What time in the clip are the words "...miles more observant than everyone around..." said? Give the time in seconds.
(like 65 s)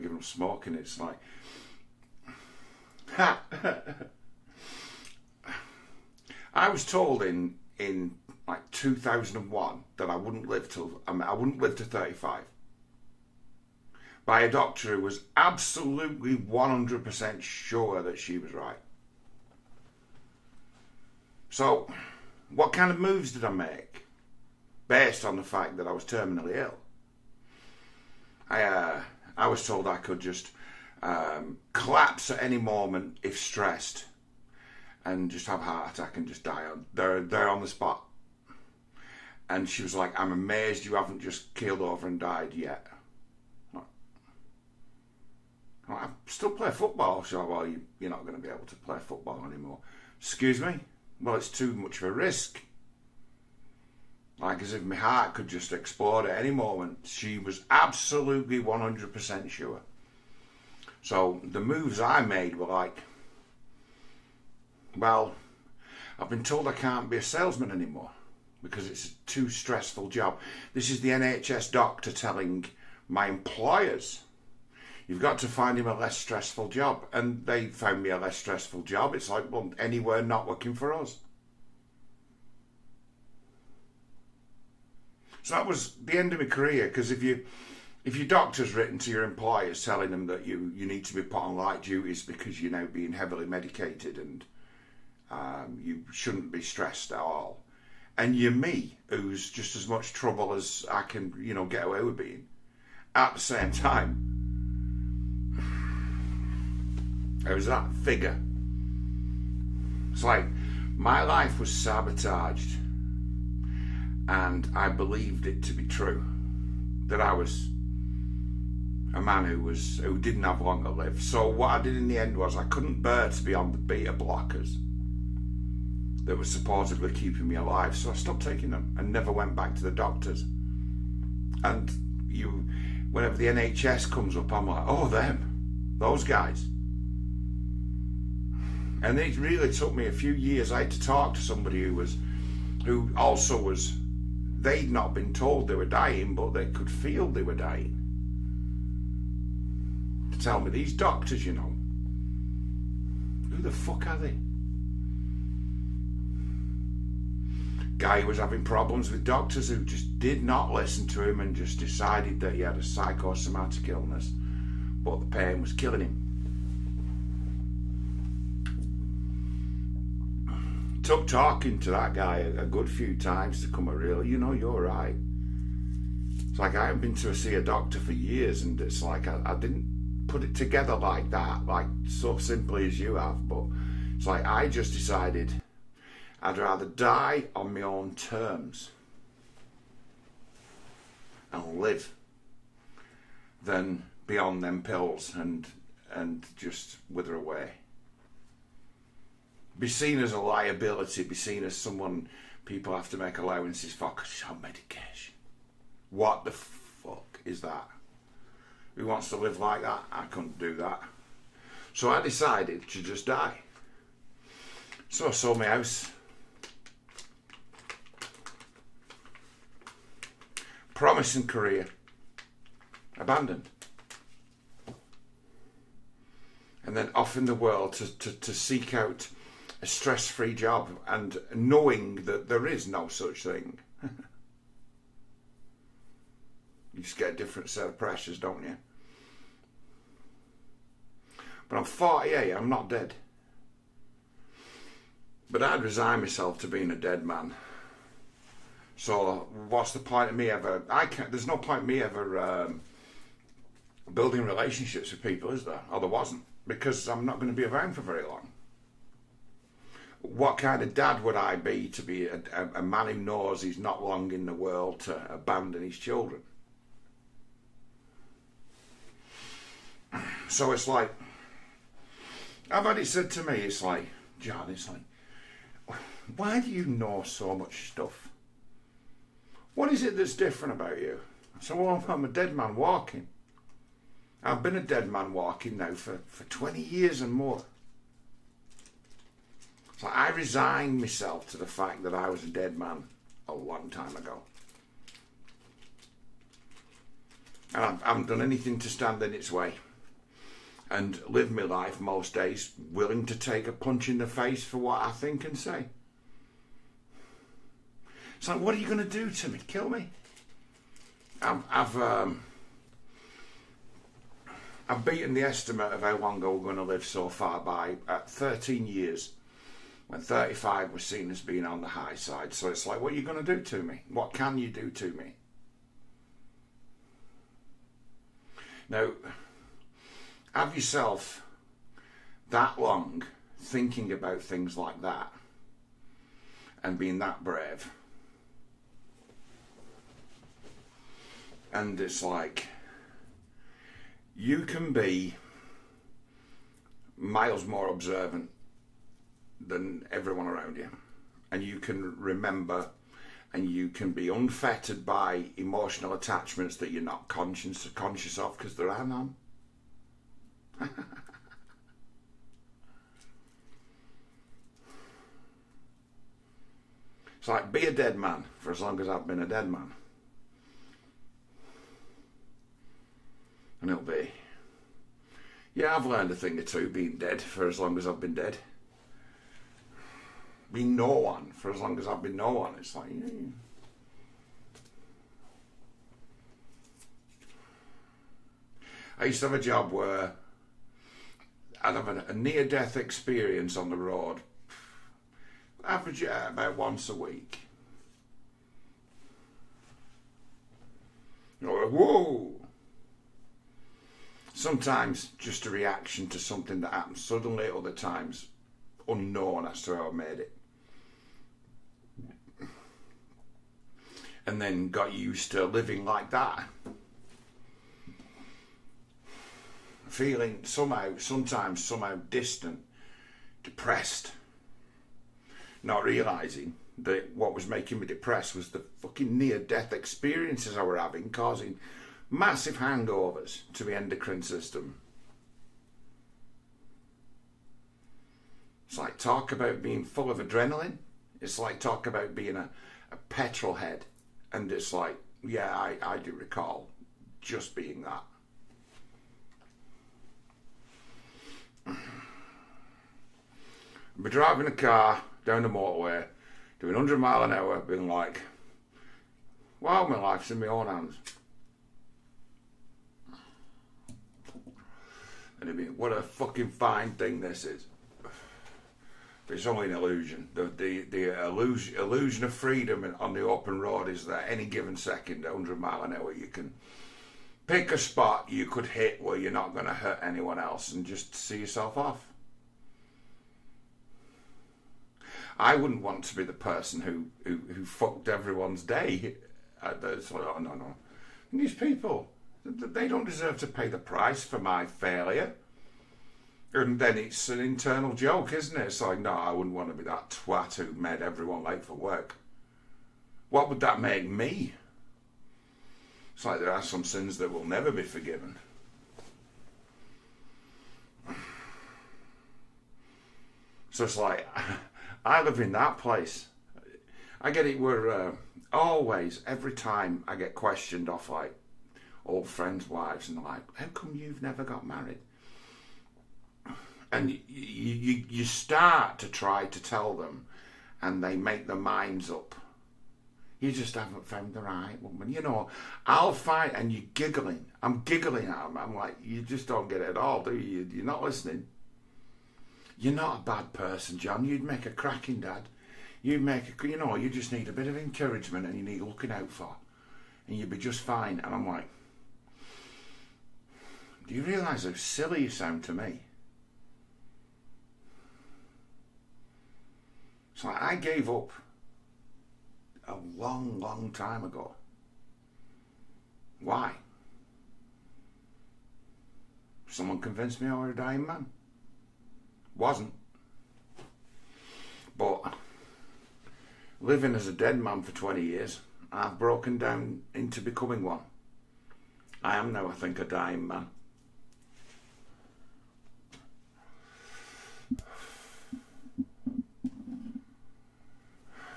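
347 s.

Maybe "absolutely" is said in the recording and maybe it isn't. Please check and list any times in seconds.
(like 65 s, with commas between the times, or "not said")
15 s, 57 s.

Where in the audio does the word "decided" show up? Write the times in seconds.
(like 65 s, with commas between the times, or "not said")
161 s, 184 s, 212 s.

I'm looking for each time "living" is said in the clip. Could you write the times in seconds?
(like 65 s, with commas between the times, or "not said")
415 s, 577 s.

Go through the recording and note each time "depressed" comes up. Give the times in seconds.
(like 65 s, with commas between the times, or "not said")
423 s, 428 s.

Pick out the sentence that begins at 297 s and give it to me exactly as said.
And I haven't done anything to stand in its way.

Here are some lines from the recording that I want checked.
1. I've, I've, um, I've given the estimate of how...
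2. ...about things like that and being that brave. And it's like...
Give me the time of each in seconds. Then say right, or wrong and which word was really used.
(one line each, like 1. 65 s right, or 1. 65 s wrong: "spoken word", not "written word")
1. 311 s wrong: "beaten", not "given"
2. 334 s right.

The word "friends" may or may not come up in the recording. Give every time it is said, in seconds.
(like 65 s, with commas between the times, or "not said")
522 s.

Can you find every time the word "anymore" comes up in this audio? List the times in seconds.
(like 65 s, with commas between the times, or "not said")
49 s, 67 s.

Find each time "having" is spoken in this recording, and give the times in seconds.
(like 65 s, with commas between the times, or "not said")
158 s, 430 s.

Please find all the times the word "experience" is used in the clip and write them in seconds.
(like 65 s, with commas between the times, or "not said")
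392 s, 429 s.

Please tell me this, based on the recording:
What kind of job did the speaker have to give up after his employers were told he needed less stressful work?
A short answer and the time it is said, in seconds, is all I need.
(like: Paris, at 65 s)
Salesman, at 67 s.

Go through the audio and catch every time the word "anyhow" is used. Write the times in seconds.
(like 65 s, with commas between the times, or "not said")
not said.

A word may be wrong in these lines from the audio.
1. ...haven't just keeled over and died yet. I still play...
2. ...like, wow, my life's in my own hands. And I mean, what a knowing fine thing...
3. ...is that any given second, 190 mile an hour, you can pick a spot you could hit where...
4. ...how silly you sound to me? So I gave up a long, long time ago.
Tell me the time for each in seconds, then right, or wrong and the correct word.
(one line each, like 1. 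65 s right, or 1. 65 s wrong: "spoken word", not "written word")
1. 40 s right
2. 458 s wrong: "fucking", not "knowing"
3. 474 s wrong: "100", not "190"
4. 554 s right.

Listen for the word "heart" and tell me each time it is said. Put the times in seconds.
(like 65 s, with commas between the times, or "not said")
35 s, 54 s.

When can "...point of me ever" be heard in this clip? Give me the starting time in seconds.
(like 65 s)
249 s.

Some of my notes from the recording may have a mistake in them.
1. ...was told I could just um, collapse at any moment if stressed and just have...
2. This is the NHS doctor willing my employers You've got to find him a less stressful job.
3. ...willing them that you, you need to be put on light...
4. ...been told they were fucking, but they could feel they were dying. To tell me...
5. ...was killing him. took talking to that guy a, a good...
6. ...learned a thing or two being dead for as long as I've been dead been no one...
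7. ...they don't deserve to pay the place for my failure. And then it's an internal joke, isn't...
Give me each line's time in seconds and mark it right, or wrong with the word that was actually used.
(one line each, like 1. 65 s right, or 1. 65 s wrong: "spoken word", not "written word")
1. 29 s right
2. 70 s wrong: "telling", not "willing"
3. 89 s wrong: "telling", not "willing"
4. 145 s wrong: "dying", not "fucking"
5. 165 s right
6. 376 s right
7. 492 s wrong: "price", not "place".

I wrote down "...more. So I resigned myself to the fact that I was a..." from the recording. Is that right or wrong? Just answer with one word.
right.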